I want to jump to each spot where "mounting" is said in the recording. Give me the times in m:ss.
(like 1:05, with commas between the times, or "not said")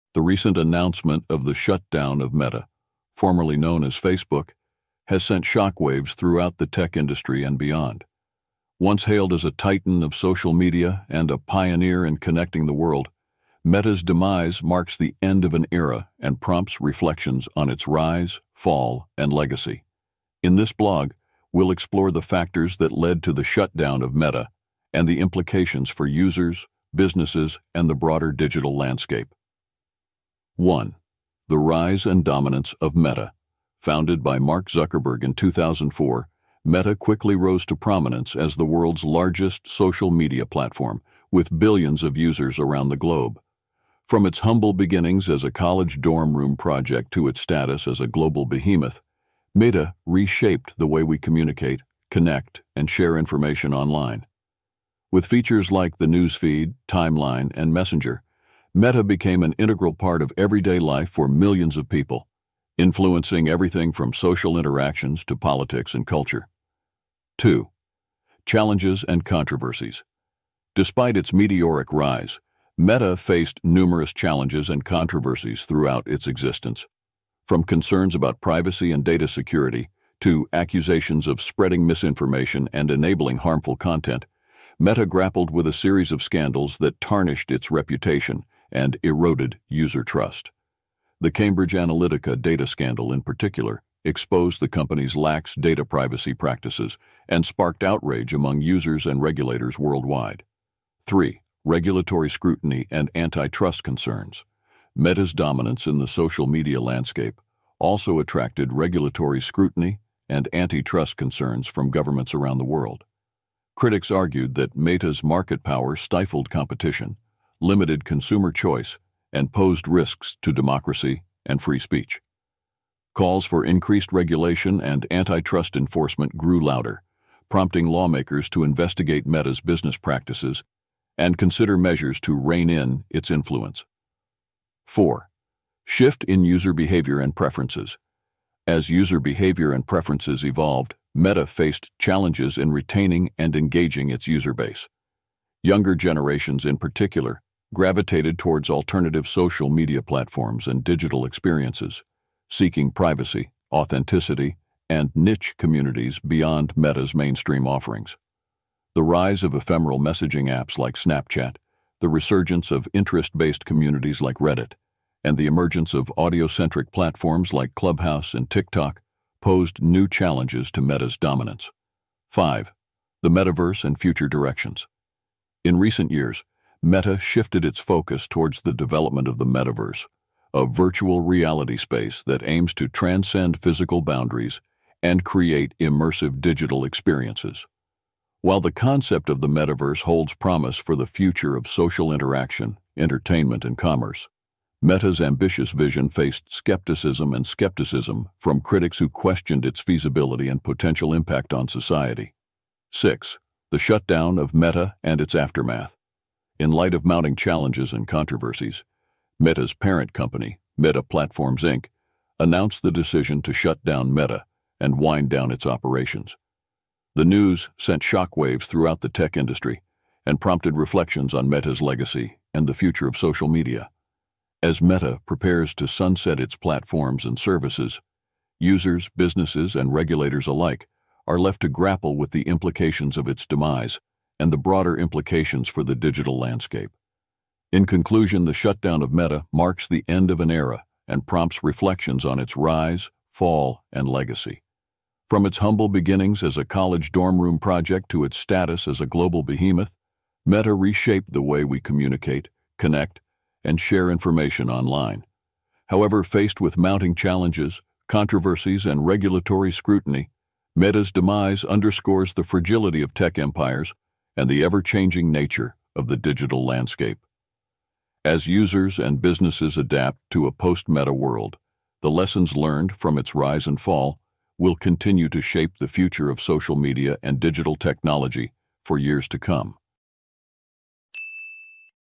3:27, 4:16.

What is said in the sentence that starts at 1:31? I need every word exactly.
The Cambridge Analytica data scandal, in particular, exposed the company's lax data privacy practices and sparked outrage among users and regulators worldwide.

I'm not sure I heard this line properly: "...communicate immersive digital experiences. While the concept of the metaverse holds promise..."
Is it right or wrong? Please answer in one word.
wrong.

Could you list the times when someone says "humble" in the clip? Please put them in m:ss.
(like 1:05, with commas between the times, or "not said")
0:44, 4:05.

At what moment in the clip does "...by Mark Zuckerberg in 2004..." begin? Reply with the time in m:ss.
0:34.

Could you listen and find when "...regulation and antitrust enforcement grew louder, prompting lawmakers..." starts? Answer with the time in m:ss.
2:04.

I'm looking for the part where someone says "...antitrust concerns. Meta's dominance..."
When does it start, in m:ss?
1:43.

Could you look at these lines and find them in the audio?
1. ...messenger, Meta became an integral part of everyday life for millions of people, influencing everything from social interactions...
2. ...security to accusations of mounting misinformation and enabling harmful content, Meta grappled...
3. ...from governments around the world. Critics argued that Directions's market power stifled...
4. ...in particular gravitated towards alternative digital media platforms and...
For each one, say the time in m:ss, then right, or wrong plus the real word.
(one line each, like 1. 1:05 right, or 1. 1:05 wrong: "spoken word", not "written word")
1. 0:57 right
2. 1:19 wrong: "spreading", not "mounting"
3. 1:51 wrong: "Meta", not "Directions"
4. 2:26 wrong: "social", not "digital".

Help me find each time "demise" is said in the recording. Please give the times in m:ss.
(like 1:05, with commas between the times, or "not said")
0:14, 3:53, 4:21.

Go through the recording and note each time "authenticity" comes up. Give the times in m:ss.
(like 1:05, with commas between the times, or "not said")
2:33.